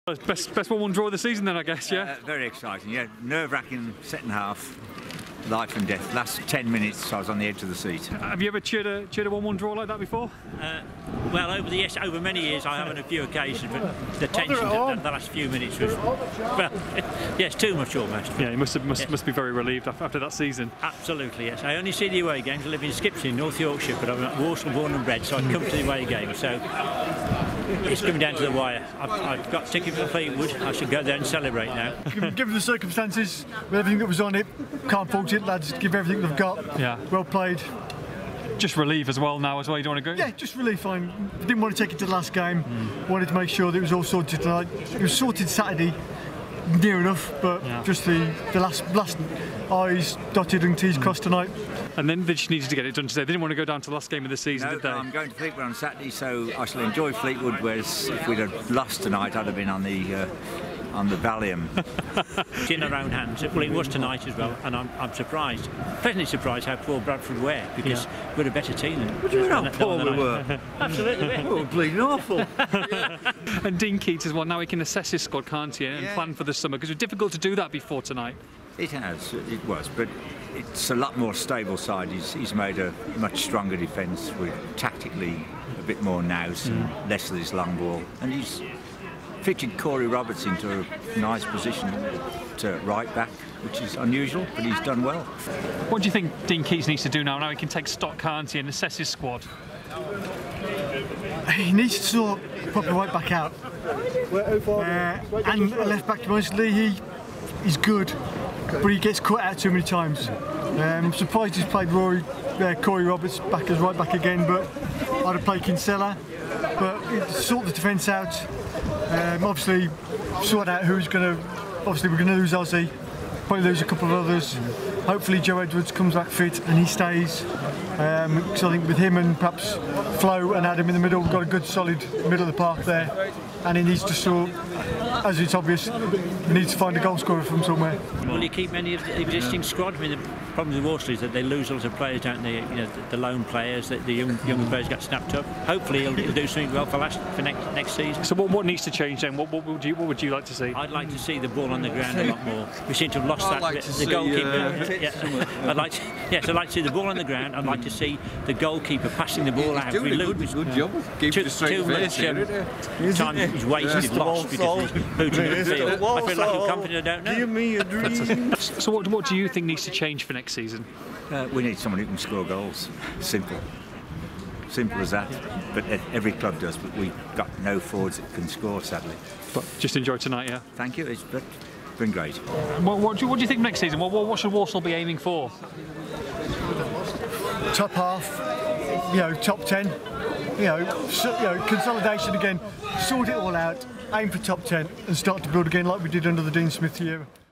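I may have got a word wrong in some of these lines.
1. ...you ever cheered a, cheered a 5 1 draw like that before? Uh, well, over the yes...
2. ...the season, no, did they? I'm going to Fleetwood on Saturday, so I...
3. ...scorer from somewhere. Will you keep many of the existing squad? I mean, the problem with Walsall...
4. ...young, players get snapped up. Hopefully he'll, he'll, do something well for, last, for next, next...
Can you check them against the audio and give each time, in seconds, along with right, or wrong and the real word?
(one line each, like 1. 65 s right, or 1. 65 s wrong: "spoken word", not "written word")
1. 8 s wrong: "1", not "5"
2. 54 s right
3. 137 s right
4. 144 s right.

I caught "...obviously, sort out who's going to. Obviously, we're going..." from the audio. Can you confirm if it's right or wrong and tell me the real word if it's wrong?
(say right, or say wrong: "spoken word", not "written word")
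right.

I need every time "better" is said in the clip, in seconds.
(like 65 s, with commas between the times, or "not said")
68 s.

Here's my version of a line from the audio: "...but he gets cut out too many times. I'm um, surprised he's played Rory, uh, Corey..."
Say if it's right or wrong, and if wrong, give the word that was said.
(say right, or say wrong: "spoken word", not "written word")
right.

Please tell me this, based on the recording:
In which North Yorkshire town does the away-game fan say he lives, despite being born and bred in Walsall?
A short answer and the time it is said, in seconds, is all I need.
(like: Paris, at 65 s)
Skipton, at 22 s.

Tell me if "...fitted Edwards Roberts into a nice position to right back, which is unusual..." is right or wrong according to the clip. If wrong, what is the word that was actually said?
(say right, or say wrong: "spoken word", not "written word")
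wrong: "Corey", not "Edwards".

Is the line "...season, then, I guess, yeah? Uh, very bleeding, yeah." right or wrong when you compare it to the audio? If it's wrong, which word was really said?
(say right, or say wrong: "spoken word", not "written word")
wrong: "exciting", not "bleeding".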